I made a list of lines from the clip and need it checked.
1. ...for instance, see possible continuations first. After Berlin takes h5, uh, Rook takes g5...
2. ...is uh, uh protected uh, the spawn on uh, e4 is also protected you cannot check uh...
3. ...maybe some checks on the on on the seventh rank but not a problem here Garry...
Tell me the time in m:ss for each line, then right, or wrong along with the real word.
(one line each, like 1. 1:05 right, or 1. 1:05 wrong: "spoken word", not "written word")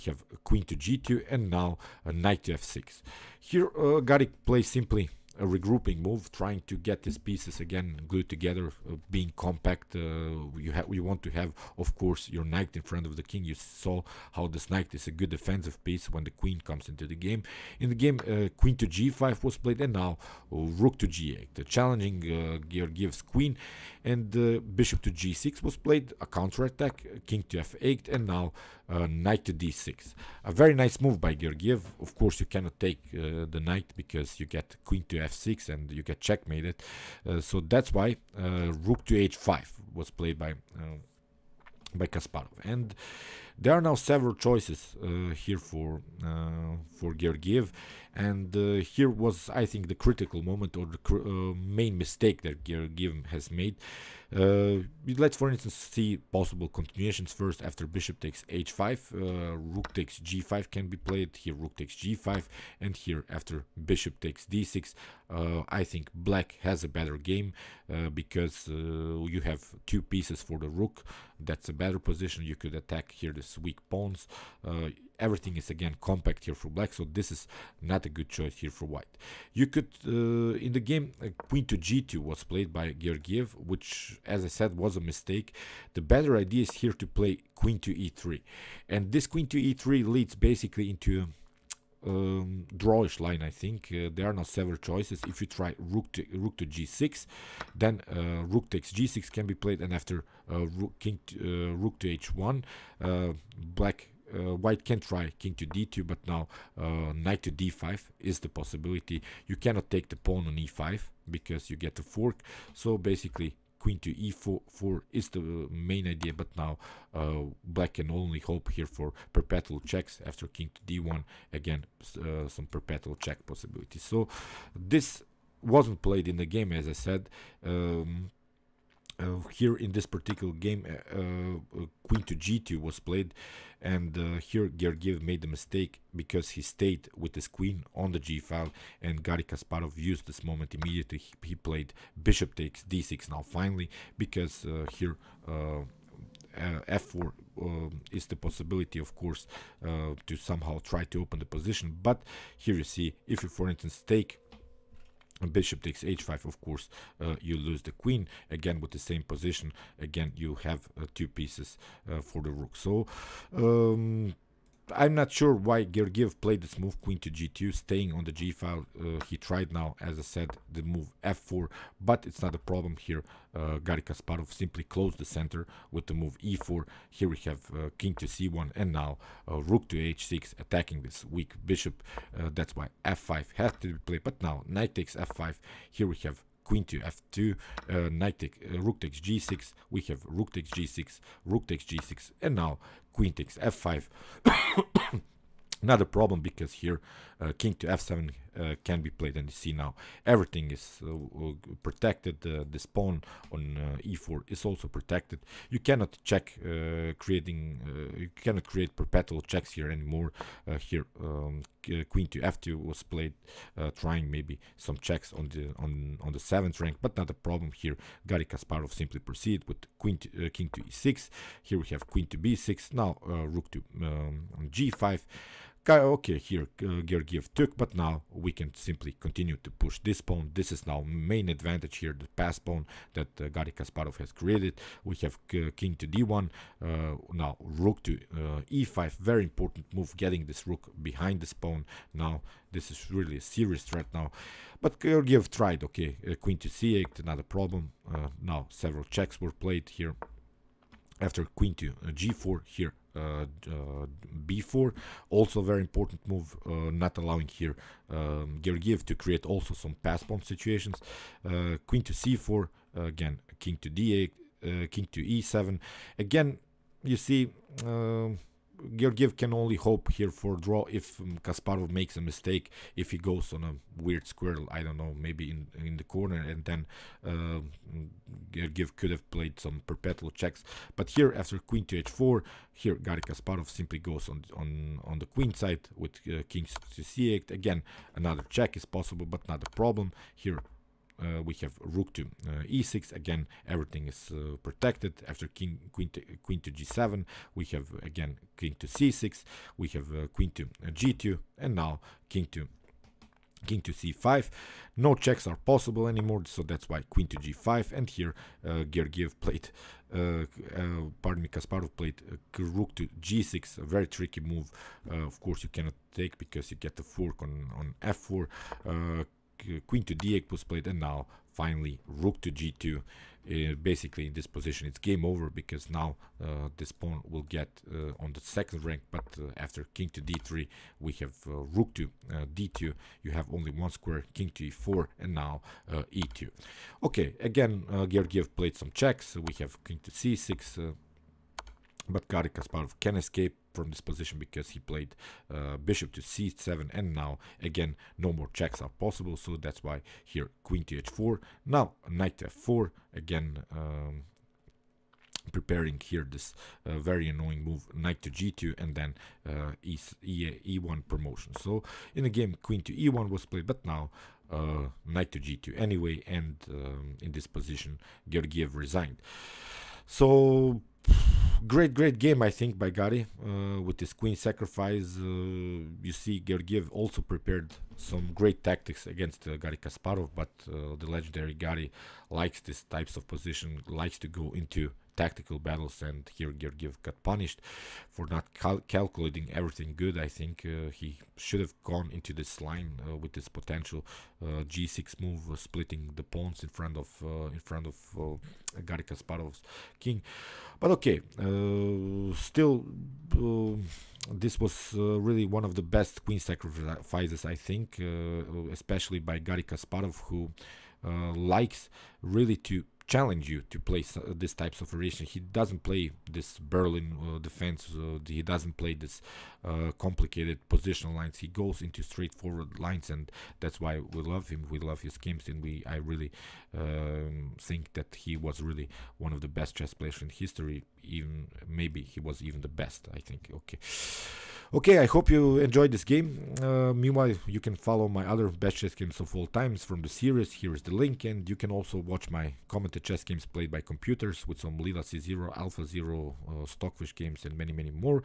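1. 0:55 wrong: "Bishop", not "Berlin"
2. 3:20 right
3. 3:34 right.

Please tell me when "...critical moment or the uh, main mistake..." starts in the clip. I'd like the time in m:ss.
0:49.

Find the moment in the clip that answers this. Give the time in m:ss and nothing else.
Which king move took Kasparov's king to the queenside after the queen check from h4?
4:46.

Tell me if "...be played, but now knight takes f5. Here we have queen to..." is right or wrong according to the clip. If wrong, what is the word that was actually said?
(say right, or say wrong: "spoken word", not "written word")
right.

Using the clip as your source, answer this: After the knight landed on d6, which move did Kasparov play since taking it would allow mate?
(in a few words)
Rook to h5.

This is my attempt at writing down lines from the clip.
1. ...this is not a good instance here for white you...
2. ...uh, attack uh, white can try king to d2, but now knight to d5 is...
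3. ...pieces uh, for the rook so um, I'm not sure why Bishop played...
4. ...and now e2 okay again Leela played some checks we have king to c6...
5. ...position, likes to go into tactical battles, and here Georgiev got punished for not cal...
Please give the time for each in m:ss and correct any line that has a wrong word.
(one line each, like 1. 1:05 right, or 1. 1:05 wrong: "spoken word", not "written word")
1. 1:17 wrong: "choice", not "instance"
2. 1:43 wrong: "black", not "attack"
3. 2:41 wrong: "Georgiev", not "Bishop"
4. 5:35 wrong: "Georgiev", not "Leela"
5. 6:23 right.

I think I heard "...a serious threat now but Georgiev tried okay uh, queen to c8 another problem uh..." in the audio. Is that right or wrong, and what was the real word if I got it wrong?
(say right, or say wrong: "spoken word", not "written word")
right.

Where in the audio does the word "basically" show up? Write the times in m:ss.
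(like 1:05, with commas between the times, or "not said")
1:30, 1:52, 5:23.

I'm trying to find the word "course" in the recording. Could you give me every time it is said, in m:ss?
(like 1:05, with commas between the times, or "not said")
0:11, 0:32, 2:29, 2:36, 5:15.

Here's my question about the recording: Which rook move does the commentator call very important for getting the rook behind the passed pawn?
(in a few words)
Rook to e5.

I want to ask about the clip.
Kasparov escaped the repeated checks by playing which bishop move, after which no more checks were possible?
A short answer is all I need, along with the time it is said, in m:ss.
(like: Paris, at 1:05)
Bishop to c7, at 5:45.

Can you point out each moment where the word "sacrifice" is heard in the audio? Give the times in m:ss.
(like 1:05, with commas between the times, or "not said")
6:14, 6:46.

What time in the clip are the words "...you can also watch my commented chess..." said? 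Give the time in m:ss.
7:21.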